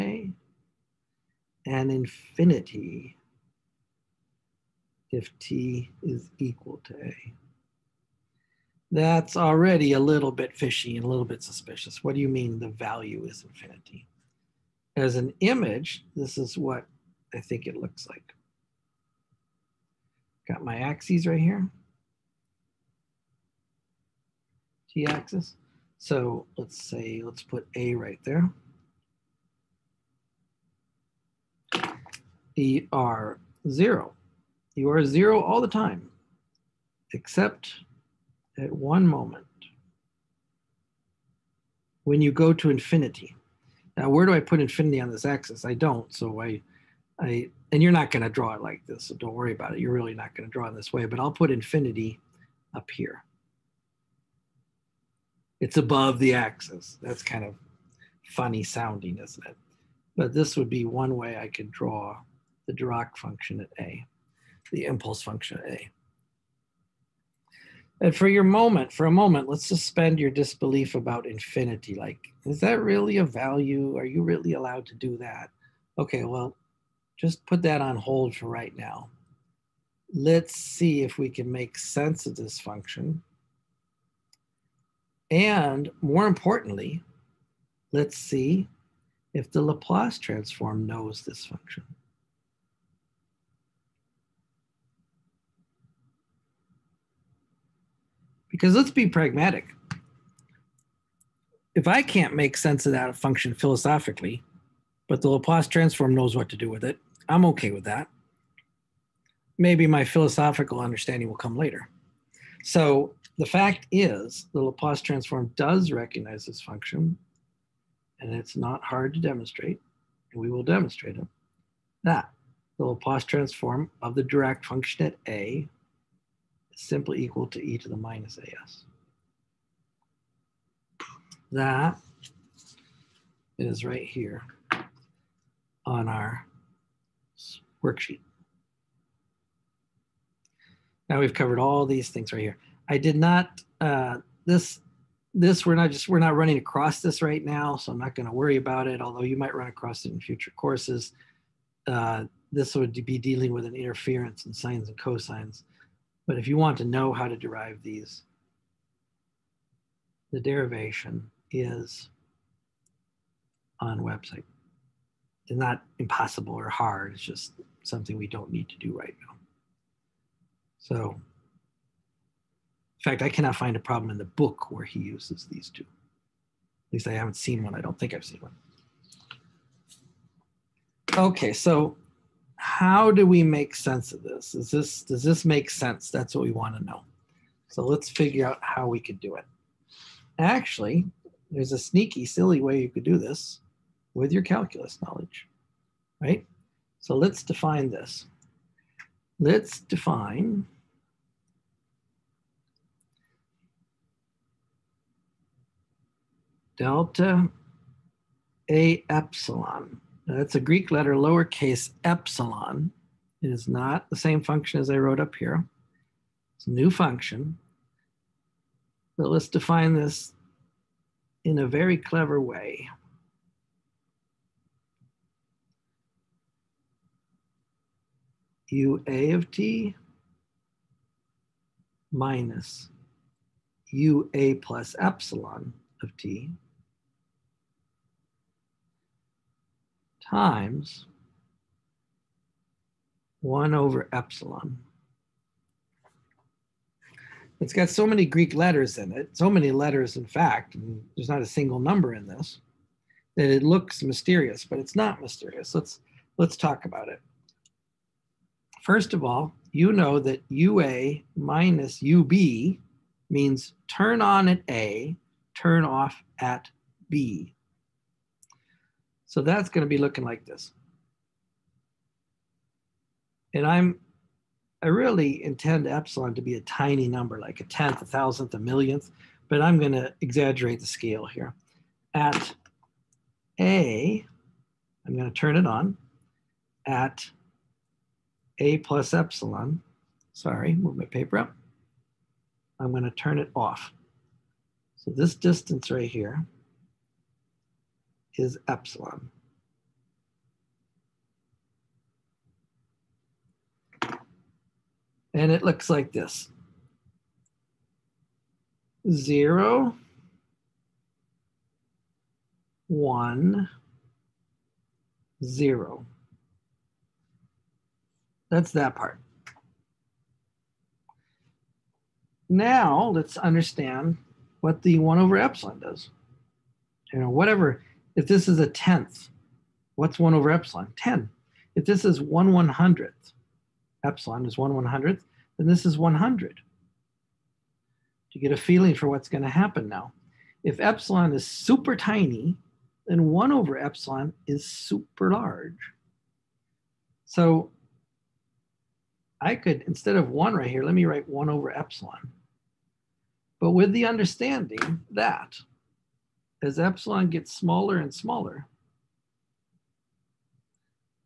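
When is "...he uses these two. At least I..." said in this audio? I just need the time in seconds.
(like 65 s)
174 s.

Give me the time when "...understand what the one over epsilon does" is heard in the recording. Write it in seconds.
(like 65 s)
323 s.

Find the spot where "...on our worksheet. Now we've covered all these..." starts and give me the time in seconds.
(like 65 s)
135 s.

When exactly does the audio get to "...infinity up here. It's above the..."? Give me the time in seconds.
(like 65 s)
51 s.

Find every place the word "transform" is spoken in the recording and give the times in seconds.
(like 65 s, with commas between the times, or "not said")
90 s, 105 s, 115 s, 123 s.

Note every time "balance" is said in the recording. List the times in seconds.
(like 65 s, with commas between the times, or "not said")
not said.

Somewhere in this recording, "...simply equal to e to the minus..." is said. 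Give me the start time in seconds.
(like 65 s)
126 s.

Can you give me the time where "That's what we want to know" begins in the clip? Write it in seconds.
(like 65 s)
186 s.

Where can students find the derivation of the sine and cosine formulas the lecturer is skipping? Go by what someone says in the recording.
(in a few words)
website.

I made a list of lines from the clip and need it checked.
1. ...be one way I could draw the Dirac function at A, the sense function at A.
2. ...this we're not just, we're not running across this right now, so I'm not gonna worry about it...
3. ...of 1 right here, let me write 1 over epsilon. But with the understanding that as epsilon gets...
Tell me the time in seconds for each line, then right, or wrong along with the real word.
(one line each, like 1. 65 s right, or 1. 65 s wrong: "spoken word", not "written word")
1. 60 s wrong: "impulse", not "sense"
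2. 145 s right
3. 350 s right.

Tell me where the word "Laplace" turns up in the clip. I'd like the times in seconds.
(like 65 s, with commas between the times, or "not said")
89 s, 105 s, 114 s, 122 s.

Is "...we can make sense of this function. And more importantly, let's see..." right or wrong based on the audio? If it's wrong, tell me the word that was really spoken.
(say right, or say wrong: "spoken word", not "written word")
right.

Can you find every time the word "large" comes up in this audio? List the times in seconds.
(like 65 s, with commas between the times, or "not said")
345 s.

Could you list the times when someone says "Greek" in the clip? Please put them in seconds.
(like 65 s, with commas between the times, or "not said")
210 s, 248 s.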